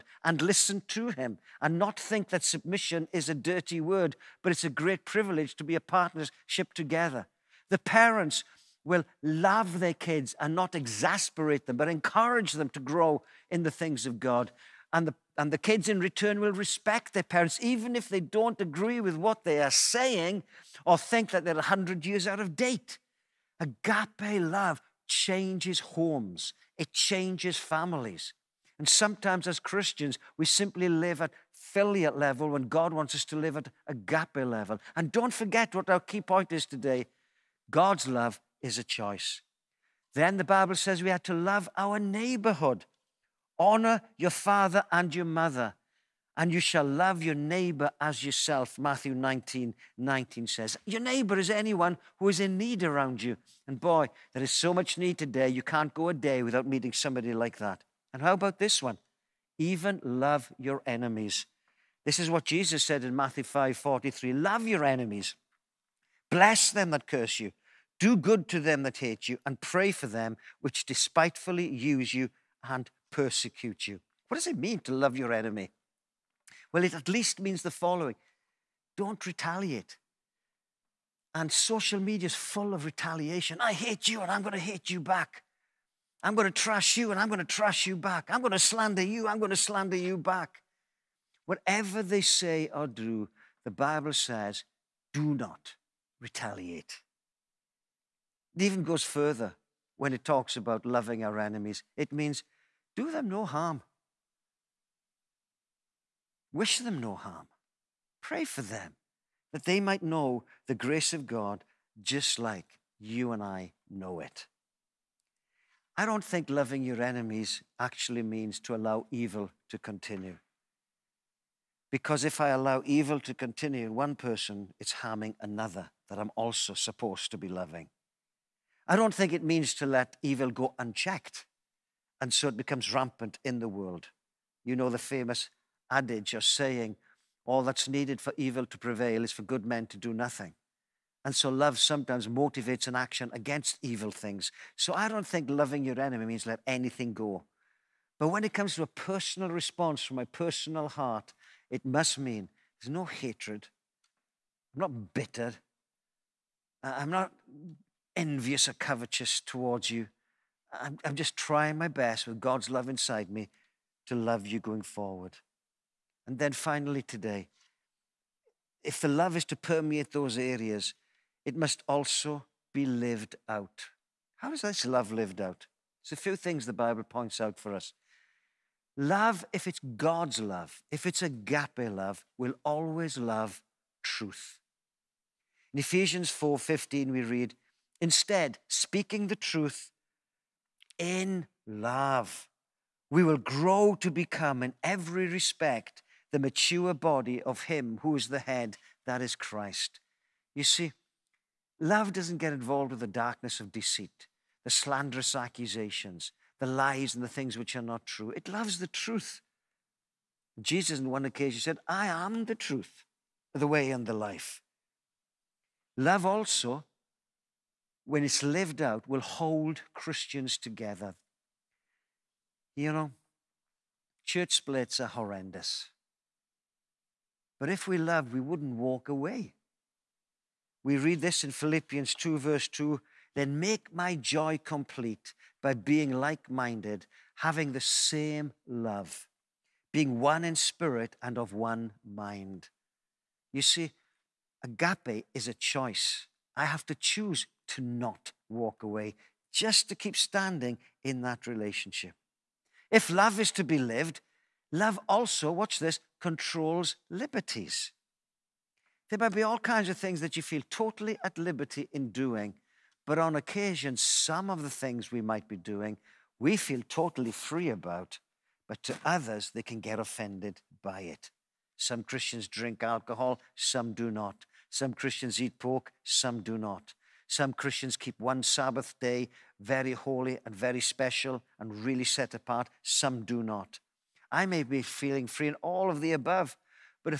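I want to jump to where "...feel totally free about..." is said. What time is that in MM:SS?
04:26.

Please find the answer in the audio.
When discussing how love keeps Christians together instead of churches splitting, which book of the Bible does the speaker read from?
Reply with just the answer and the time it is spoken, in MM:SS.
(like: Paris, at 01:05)
Philippians, at 03:51.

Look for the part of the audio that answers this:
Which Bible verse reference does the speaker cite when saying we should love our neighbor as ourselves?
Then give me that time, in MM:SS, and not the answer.
00:48.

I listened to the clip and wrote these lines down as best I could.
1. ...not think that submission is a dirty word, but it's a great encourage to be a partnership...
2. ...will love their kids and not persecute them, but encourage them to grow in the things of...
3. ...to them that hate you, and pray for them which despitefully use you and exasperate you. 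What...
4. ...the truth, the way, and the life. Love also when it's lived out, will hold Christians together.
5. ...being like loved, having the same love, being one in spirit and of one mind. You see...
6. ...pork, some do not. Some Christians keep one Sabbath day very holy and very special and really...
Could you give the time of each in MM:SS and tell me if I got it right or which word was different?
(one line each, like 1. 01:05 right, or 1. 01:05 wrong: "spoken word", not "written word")
1. 00:01 wrong: "privilege", not "encourage"
2. 00:08 wrong: "exasperate", not "persecute"
3. 01:08 wrong: "persecute", not "exasperate"
4. 03:32 right
5. 03:55 wrong: "minded", not "loved"
6. 04:35 right.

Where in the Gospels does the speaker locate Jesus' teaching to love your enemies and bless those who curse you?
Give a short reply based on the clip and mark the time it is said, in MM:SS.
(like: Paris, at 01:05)
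Matthew 5:43, at 01:03.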